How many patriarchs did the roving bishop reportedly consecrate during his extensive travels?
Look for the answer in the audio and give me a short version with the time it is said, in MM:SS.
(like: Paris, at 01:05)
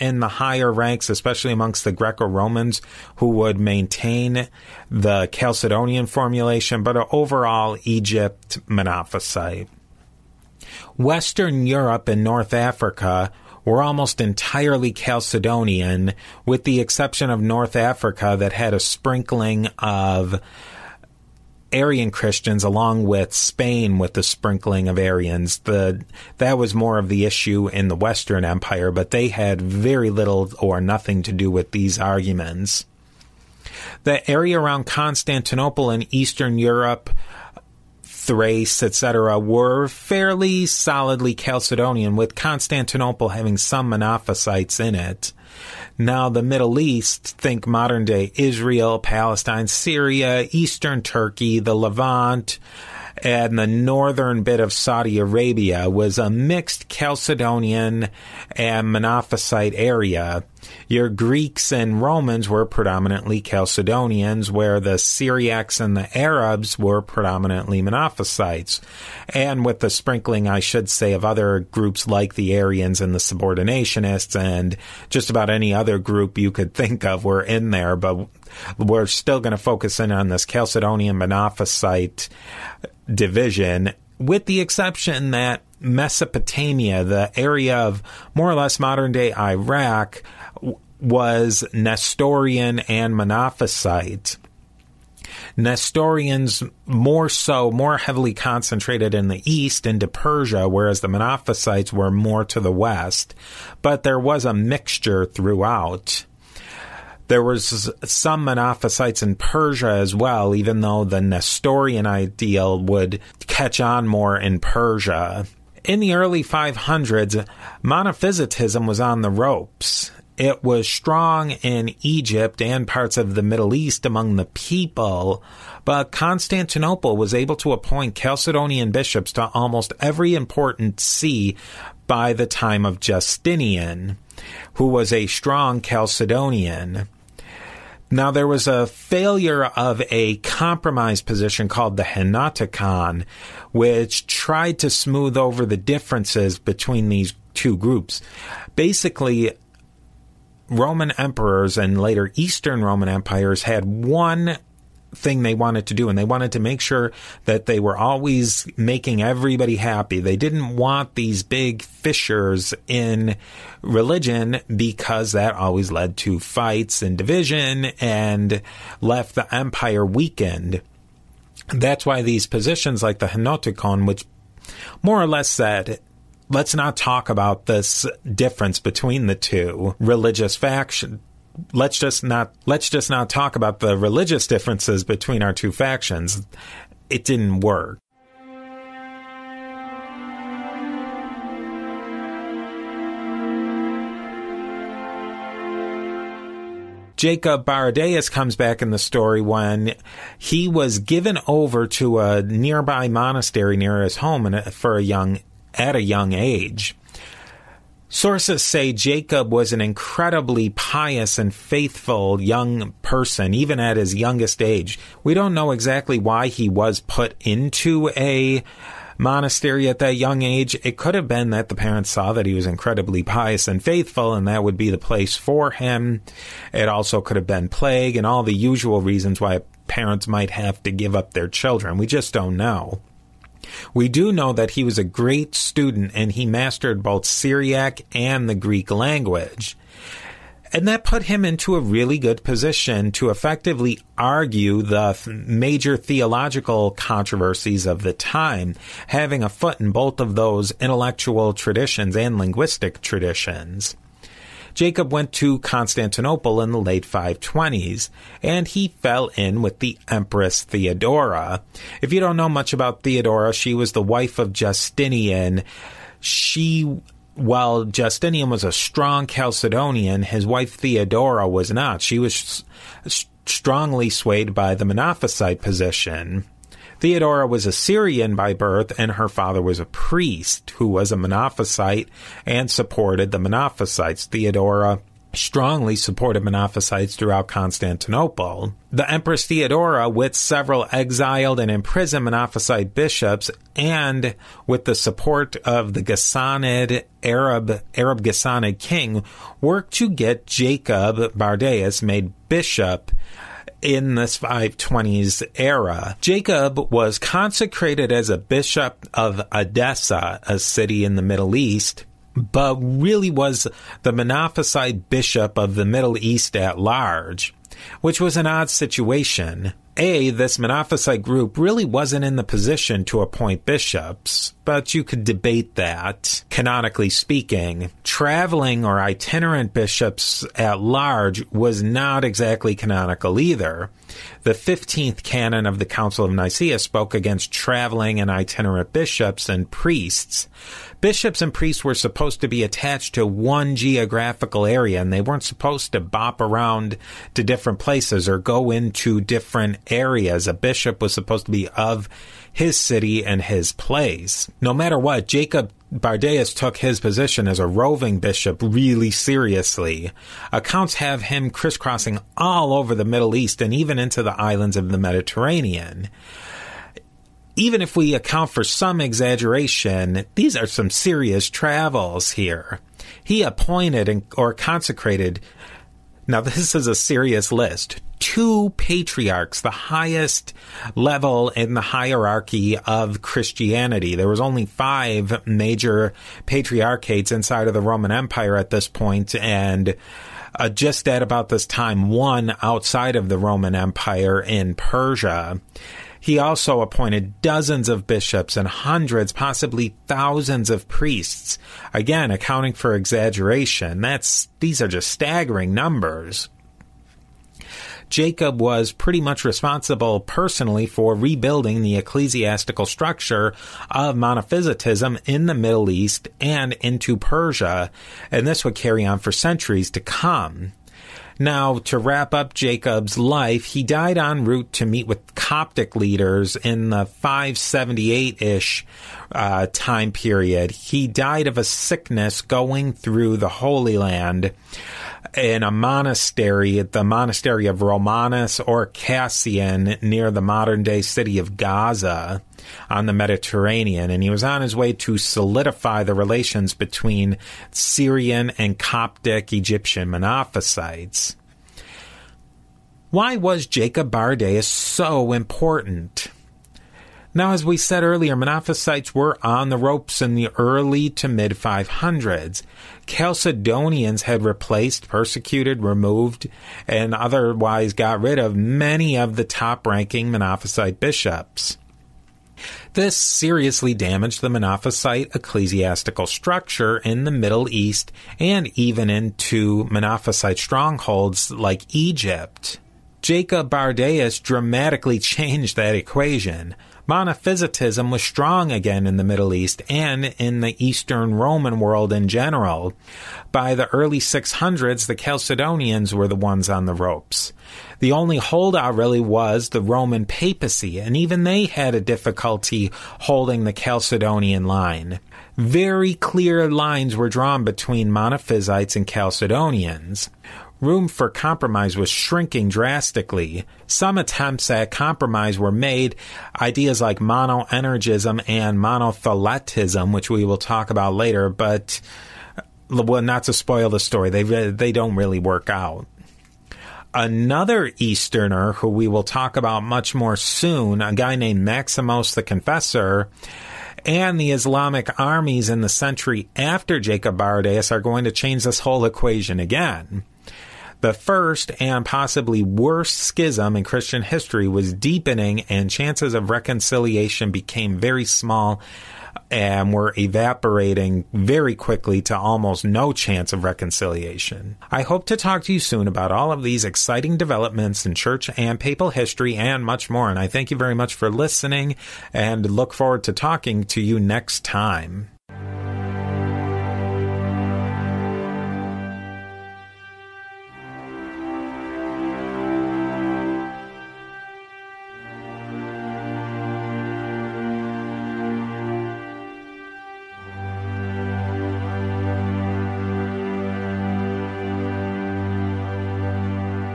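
2, at 06:18.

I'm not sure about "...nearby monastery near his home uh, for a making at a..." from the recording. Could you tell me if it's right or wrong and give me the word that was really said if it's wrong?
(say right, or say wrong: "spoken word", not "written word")
wrong: "young", not "making".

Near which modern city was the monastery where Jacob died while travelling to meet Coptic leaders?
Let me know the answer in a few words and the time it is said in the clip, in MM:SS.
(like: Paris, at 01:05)
Gaza, at 07:21.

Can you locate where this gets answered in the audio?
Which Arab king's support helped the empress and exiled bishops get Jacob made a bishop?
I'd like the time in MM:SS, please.
04:58.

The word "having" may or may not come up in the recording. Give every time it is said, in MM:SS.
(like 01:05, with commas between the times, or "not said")
00:43, 04:09.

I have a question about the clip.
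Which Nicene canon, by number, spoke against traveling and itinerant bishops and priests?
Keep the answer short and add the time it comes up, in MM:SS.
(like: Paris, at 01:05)
15th, at 05:34.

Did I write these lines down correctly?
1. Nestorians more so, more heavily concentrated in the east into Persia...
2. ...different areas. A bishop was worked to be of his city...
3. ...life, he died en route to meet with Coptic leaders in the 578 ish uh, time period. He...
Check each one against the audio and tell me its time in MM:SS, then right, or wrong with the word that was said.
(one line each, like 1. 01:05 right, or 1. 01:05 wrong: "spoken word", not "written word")
1. 01:35 right
2. 05:49 wrong: "supposed", not "worked"
3. 07:03 right.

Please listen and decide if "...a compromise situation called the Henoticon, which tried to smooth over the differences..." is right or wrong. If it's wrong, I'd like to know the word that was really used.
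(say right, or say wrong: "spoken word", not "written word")
wrong: "position", not "situation".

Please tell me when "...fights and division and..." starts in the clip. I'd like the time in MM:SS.
02:46.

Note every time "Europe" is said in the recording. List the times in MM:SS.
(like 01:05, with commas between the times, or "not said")
00:11, 00:36.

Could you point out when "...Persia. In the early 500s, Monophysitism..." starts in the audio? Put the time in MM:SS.
01:54.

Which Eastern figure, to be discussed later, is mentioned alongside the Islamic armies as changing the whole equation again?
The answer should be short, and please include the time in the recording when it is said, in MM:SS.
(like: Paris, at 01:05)
Maximus the Confessor, at 08:51.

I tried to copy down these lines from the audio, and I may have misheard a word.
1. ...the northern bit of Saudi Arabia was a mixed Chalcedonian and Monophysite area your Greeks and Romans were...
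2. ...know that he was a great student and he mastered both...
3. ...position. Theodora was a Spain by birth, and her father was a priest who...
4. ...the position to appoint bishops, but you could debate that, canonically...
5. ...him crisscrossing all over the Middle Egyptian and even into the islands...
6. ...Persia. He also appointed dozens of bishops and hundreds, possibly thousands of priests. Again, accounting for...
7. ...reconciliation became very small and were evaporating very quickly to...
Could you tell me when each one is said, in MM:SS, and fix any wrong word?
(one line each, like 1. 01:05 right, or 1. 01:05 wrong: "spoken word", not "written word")
1. 00:53 right
2. 03:54 right
3. 04:35 wrong: "Syrian", not "Spain"
4. 05:22 right
5. 06:01 wrong: "East", not "Egyptian"
6. 06:34 right
7. 09:06 right.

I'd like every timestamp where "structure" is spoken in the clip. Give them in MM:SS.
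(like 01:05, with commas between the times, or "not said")
06:52, 07:56.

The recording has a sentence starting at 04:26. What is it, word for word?
She while Justinian was a strong Chalcedonian, his wife Theodora was not.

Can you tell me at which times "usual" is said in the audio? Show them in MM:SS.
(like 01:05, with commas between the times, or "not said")
03:48.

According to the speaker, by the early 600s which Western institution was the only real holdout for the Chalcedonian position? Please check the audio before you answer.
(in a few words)
The Roman papacy.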